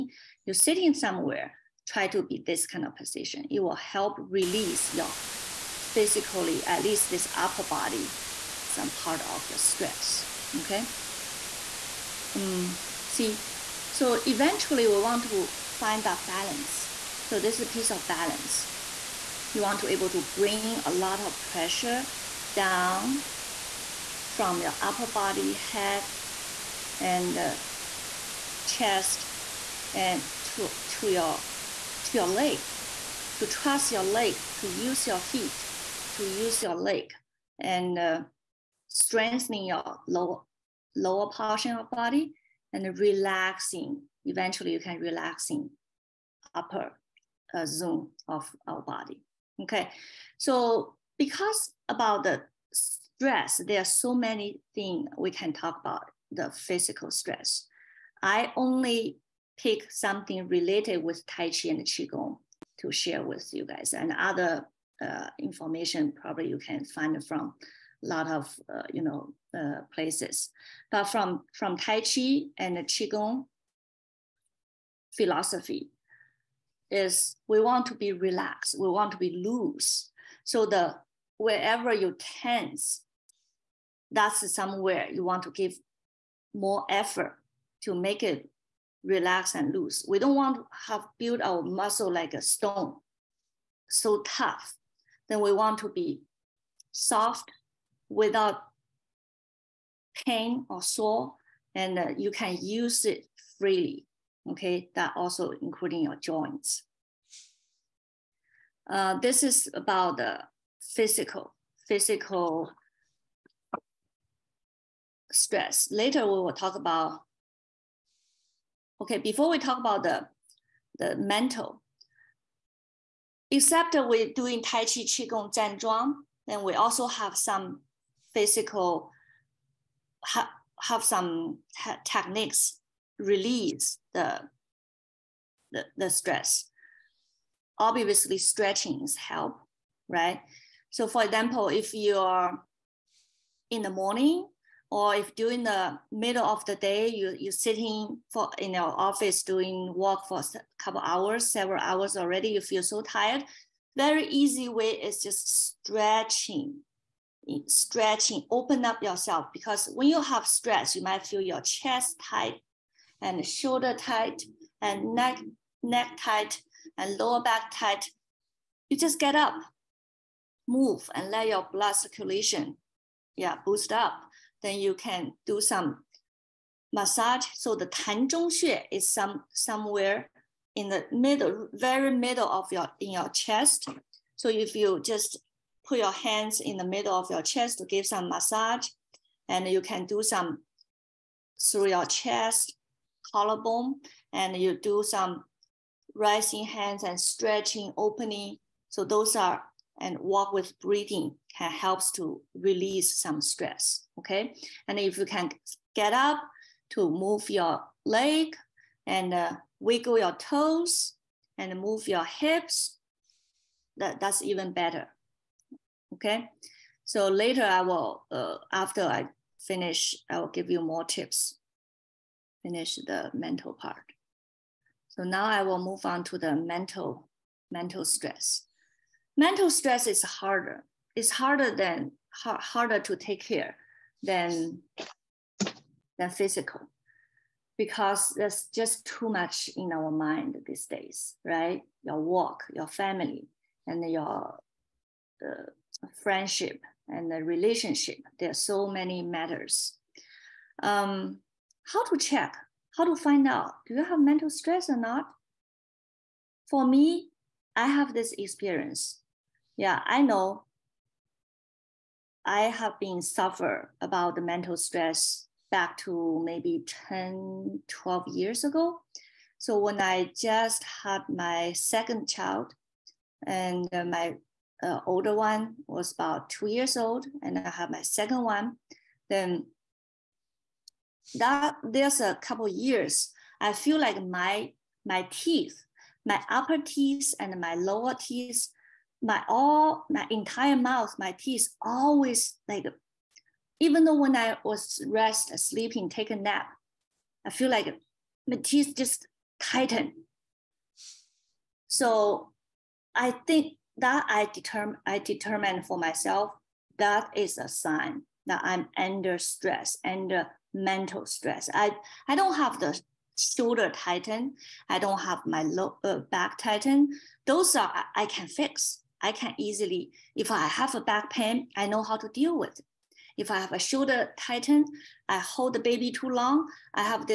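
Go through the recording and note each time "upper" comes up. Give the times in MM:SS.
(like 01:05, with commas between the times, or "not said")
00:07, 00:24, 00:46, 04:46.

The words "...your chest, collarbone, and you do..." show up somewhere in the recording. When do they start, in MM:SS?
03:11.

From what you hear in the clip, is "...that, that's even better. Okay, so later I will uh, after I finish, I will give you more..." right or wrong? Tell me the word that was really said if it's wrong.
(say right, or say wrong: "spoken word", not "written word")
right.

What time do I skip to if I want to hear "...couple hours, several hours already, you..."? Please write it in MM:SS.
02:30.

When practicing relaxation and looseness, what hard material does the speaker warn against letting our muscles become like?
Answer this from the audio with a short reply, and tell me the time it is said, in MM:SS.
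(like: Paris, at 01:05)
stone, at 01:32.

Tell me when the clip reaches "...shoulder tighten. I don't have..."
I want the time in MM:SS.
05:13.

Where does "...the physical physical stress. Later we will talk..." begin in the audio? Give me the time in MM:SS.
01:50.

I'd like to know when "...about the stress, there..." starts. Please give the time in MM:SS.
00:51.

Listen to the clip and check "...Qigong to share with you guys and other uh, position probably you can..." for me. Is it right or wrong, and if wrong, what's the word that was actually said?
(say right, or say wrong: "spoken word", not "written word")
wrong: "information", not "position".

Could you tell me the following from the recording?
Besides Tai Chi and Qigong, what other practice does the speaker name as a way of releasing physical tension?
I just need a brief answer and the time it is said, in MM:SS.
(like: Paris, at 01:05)
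Zhan Zhuang, at 02:05.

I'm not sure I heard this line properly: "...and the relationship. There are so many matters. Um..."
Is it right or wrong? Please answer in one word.
right.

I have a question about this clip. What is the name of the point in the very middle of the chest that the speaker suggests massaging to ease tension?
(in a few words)
Tan Zhong Xue.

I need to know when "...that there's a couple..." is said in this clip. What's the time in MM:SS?
04:41.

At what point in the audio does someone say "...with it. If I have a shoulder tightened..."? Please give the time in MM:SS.
05:22.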